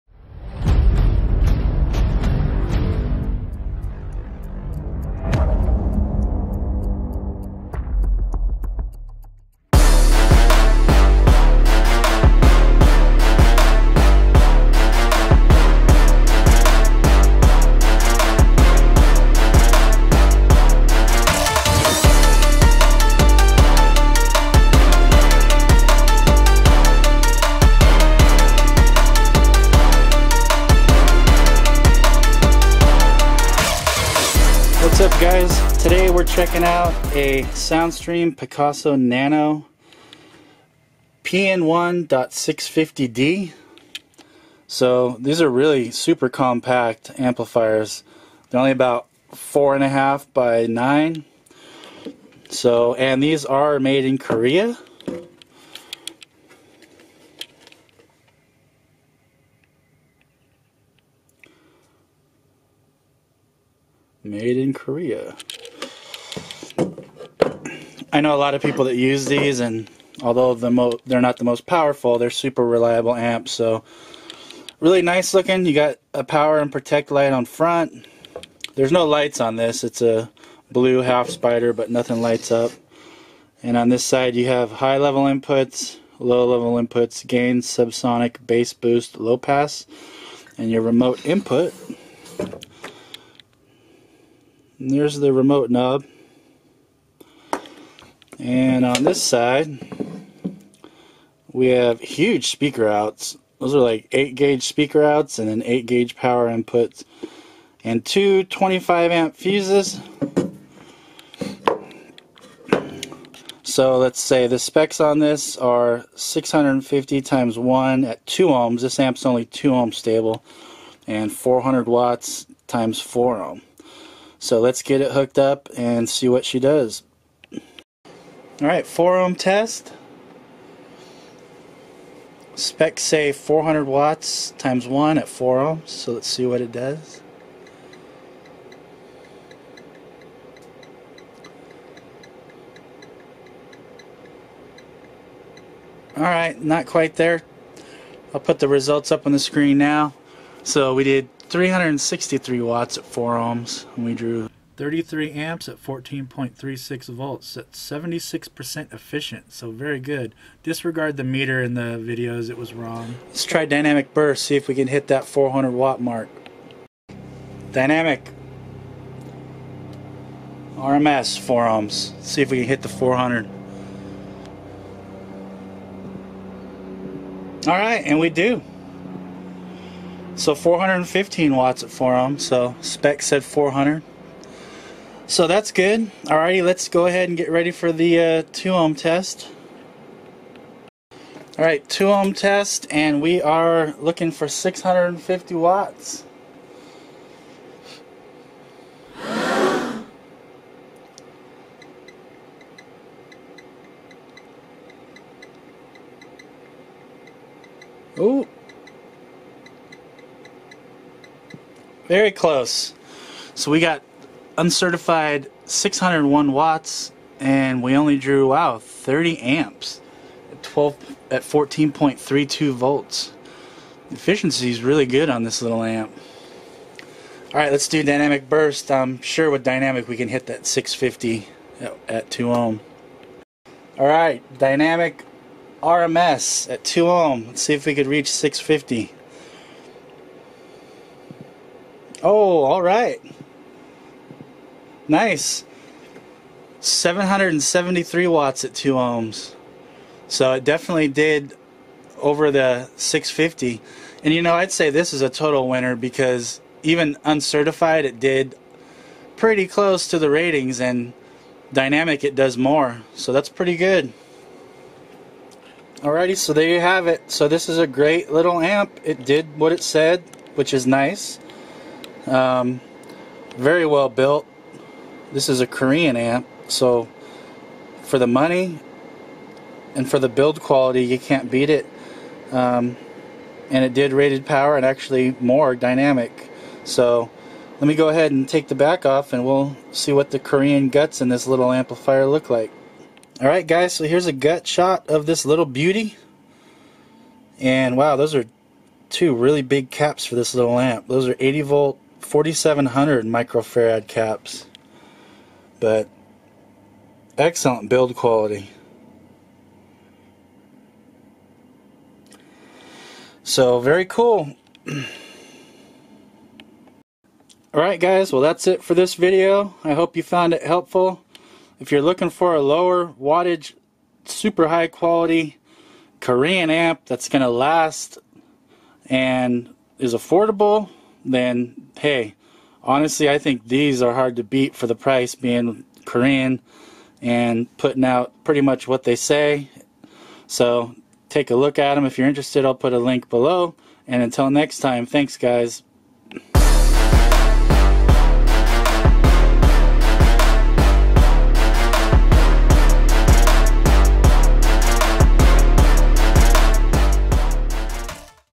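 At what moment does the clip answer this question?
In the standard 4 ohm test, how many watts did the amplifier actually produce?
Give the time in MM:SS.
02:31.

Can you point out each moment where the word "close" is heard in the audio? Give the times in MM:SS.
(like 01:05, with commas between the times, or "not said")
03:32, 04:19.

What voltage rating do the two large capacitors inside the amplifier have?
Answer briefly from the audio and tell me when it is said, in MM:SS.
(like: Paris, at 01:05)
80 volt, at 05:01.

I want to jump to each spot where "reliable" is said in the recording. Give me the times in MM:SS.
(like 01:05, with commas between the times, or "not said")
01:12.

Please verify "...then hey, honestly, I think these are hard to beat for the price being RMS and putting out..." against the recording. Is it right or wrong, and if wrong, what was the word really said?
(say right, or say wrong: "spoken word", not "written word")
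wrong: "Korean", not "RMS".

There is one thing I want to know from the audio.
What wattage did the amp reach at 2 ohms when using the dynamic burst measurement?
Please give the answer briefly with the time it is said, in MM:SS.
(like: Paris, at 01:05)
773 watts, at 04:06.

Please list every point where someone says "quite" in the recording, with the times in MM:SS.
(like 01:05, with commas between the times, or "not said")
02:26.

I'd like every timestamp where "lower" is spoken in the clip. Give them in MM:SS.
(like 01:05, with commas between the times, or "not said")
05:22.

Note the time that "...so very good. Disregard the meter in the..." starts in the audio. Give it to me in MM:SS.
02:39.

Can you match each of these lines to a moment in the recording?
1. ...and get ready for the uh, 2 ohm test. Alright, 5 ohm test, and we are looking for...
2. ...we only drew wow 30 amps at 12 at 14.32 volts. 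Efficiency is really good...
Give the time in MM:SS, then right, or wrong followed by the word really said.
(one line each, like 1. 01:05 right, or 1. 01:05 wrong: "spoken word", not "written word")
1. 03:07 wrong: "2", not "5"
2. 03:37 right.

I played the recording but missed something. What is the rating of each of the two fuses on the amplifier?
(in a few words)
25 amp.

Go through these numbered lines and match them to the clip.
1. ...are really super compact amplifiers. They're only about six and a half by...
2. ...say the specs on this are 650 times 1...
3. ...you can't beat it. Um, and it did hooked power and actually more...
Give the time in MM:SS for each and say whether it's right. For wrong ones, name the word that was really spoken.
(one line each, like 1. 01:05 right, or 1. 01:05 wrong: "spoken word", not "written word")
1. 00:45 wrong: "four", not "six"
2. 01:54 right
3. 04:41 wrong: "rated", not "hooked".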